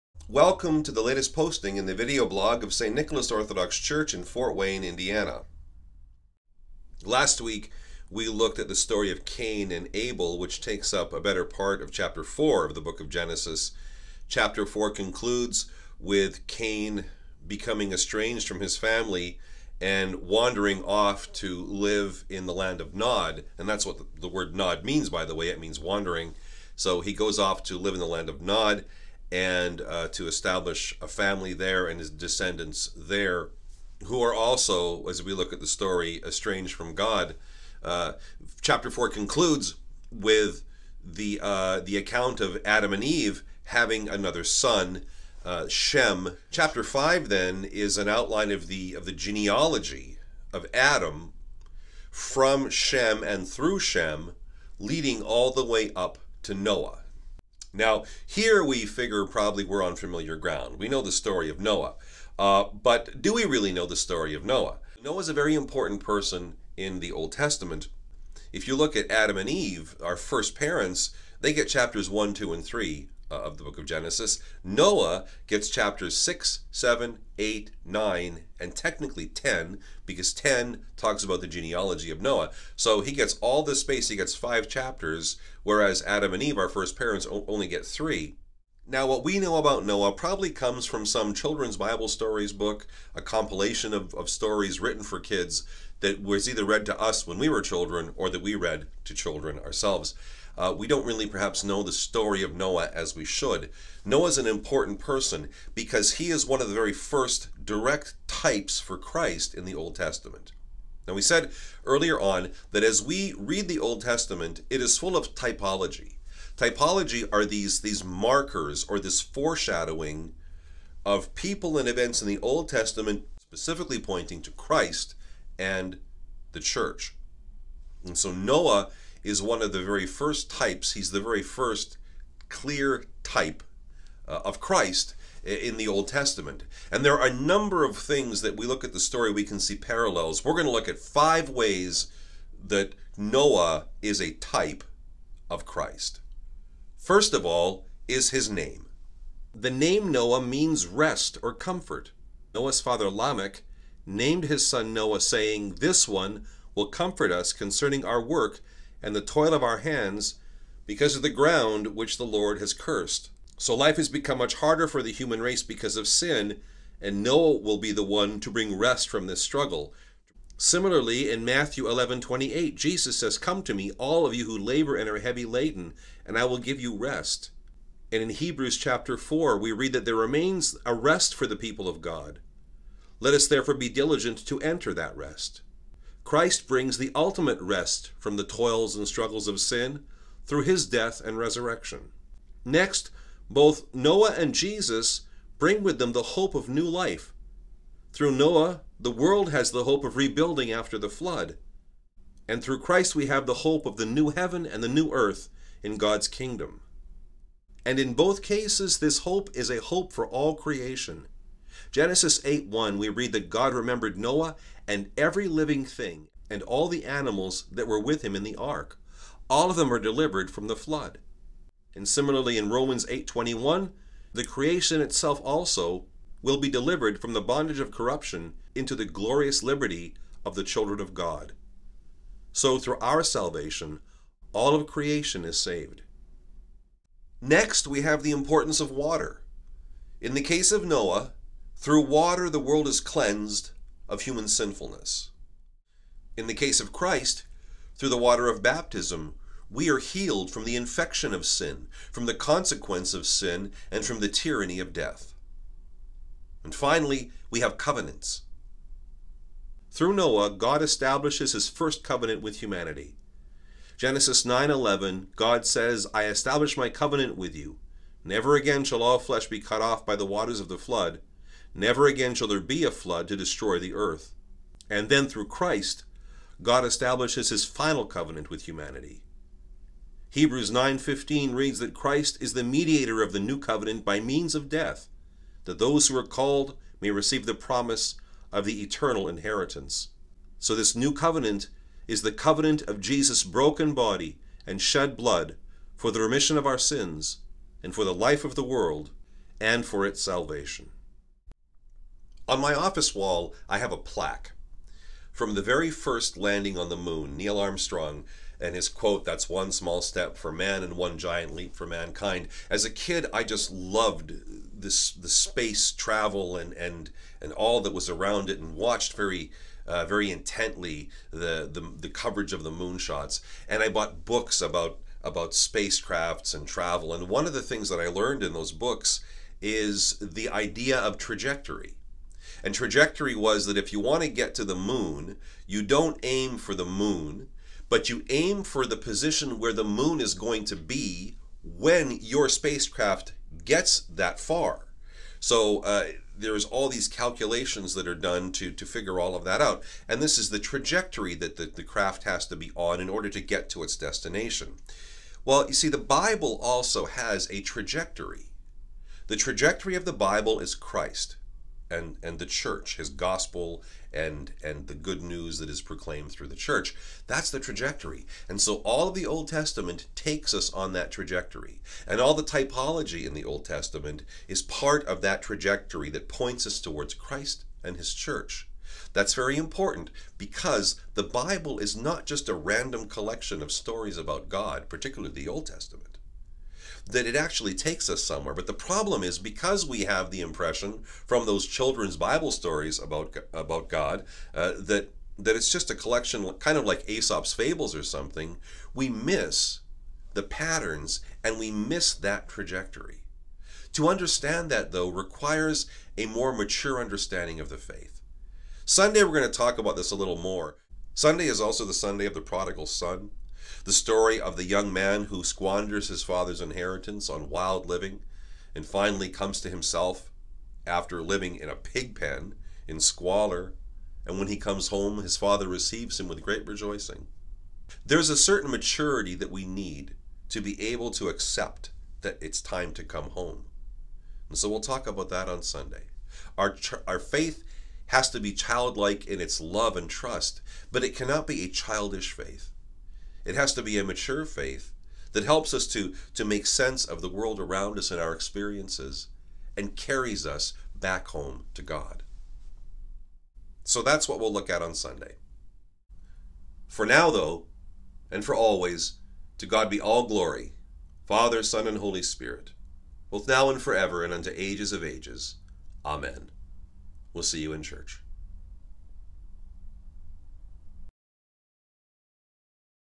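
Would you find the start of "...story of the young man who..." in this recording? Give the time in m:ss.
6:53.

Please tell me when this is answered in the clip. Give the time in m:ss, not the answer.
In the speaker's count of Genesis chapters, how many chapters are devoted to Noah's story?
1:24.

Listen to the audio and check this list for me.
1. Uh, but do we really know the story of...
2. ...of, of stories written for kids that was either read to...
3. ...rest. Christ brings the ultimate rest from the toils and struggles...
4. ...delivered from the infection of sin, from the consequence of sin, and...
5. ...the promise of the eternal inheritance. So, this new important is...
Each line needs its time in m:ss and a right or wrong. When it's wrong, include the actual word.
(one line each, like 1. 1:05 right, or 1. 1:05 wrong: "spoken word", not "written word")
1. 1:02 right
2. 1:33 right
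3. 3:05 right
4. 4:09 wrong: "healed", not "delivered"
5. 4:47 wrong: "covenant", not "important".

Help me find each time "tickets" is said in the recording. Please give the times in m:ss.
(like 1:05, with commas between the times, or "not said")
not said.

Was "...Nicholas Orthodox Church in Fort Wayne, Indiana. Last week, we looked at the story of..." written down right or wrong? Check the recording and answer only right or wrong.
right.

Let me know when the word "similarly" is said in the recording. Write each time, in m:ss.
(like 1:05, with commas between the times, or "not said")
2:50, 3:42.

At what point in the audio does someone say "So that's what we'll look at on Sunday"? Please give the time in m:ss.
7:33.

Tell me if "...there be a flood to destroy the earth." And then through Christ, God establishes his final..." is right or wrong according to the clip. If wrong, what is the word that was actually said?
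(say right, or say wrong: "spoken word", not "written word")
right.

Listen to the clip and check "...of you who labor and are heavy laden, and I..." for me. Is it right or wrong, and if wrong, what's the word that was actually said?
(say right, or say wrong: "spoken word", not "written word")
right.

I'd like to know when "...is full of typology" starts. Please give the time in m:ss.
1:54.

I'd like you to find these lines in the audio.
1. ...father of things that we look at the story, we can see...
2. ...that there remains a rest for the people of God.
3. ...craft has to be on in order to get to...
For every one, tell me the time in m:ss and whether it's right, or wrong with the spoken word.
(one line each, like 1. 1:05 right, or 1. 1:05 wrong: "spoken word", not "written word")
1. 2:17 wrong: "number", not "father"
2. 2:59 right
3. 5:51 right.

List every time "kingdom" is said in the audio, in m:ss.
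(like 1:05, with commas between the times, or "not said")
3:26.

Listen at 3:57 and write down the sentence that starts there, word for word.
Next, we have the importance of water.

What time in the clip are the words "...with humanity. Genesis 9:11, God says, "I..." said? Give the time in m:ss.
4:22.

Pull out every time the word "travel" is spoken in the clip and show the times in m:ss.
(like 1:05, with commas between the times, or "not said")
5:15, 5:26.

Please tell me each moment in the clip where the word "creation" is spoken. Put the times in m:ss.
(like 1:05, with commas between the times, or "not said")
3:30, 3:44, 3:54.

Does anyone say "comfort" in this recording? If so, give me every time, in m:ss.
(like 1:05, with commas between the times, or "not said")
2:31, 2:36.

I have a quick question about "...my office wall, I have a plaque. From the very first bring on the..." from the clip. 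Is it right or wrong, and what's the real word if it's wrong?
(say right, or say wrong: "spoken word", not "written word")
wrong: "landing", not "bring".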